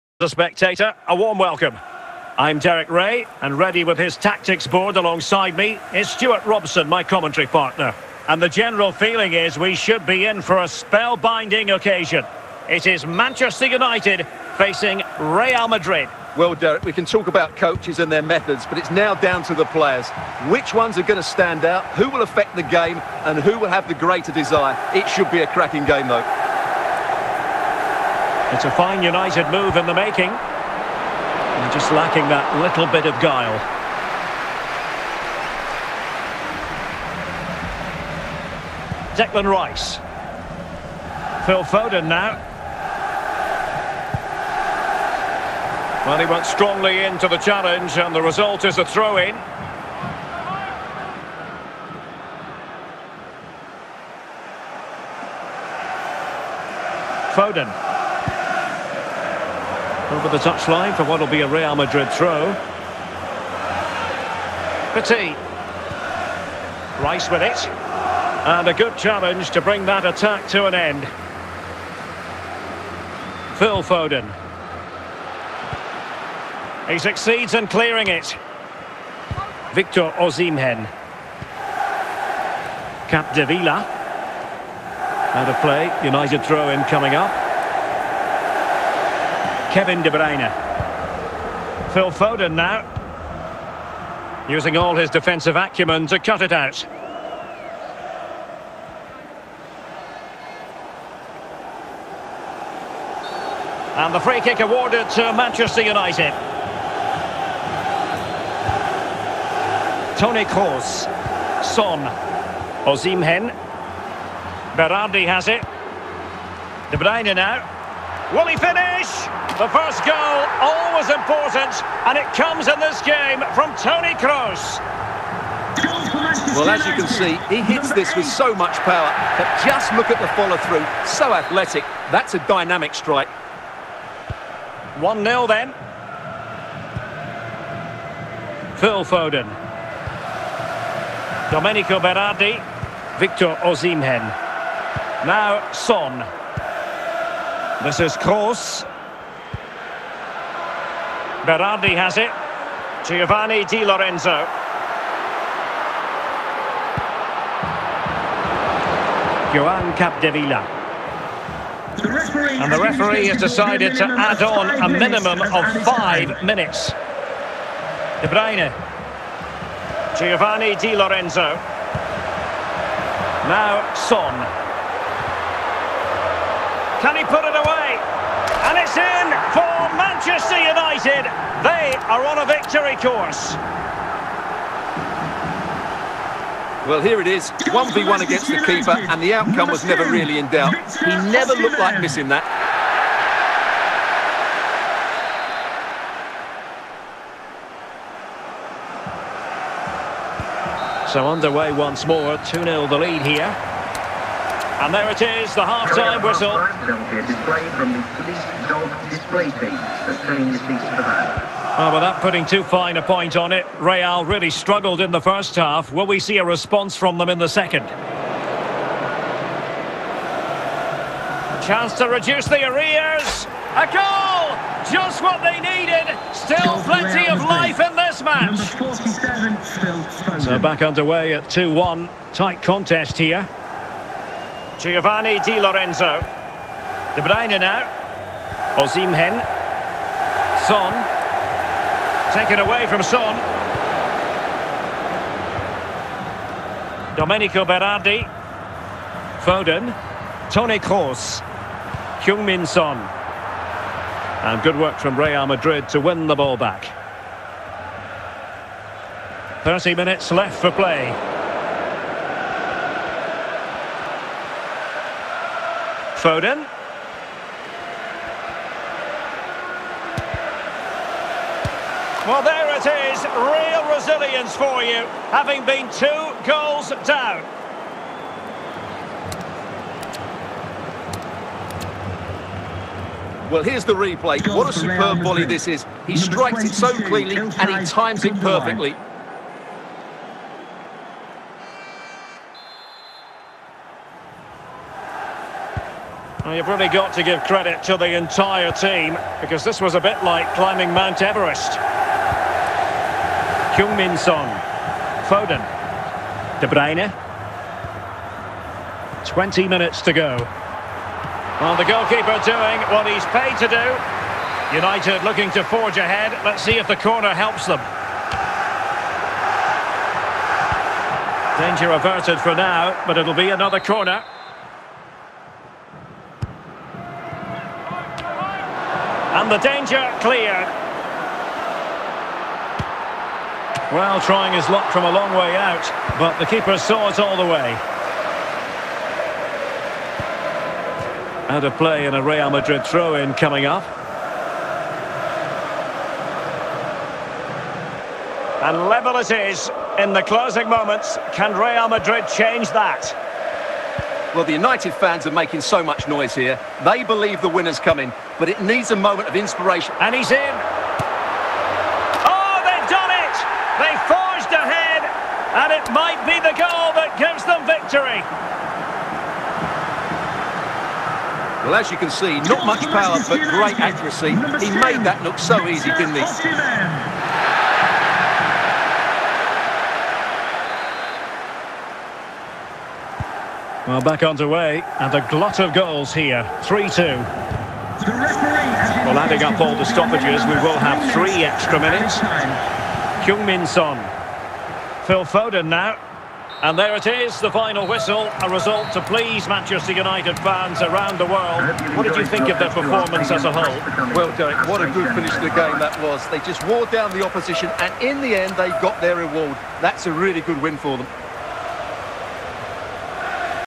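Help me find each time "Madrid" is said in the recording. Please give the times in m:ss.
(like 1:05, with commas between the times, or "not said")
0:15, 1:01, 4:15, 5:42, 5:51.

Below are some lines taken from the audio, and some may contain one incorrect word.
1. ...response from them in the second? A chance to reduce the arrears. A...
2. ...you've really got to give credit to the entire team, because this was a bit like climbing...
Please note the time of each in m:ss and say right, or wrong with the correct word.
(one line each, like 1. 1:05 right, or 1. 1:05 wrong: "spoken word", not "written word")
1. 3:36 right
2. 4:56 right.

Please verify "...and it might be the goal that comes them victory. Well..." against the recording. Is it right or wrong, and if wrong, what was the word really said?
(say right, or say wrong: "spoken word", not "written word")
wrong: "gives", not "comes".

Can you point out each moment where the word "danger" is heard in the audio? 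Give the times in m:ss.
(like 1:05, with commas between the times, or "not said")
5:21, 5:29.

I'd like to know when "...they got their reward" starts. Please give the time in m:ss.
6:48.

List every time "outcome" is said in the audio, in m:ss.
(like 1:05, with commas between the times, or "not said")
3:09.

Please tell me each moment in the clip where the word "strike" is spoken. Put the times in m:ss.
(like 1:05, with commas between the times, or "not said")
2:12, 4:46.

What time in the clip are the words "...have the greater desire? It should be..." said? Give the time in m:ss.
0:23.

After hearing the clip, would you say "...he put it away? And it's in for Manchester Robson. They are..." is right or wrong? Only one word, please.
wrong.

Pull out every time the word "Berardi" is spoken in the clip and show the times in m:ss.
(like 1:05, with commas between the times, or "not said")
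1:54, 2:21, 2:31, 4:07.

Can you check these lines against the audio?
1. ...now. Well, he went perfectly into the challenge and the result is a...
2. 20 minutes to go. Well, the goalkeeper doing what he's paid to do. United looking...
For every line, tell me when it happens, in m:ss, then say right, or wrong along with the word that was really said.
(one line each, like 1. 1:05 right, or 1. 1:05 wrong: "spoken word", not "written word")
1. 0:42 wrong: "strongly", not "perfectly"
2. 5:09 right.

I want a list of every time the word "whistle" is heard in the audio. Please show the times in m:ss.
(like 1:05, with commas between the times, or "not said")
3:26, 6:37.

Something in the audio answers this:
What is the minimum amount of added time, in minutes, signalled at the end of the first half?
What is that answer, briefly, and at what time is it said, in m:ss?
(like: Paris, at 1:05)
5, at 2:45.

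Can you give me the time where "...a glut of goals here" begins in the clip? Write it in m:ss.
6:25.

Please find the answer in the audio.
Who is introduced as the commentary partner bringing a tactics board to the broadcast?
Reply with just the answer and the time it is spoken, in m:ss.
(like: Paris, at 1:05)
Stewart Robson, at 0:06.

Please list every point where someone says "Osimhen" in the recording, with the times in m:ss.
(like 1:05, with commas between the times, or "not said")
1:20, 1:52, 2:23, 3:58.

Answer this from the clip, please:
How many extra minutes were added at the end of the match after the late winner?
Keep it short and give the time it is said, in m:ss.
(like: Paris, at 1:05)
3, at 6:31.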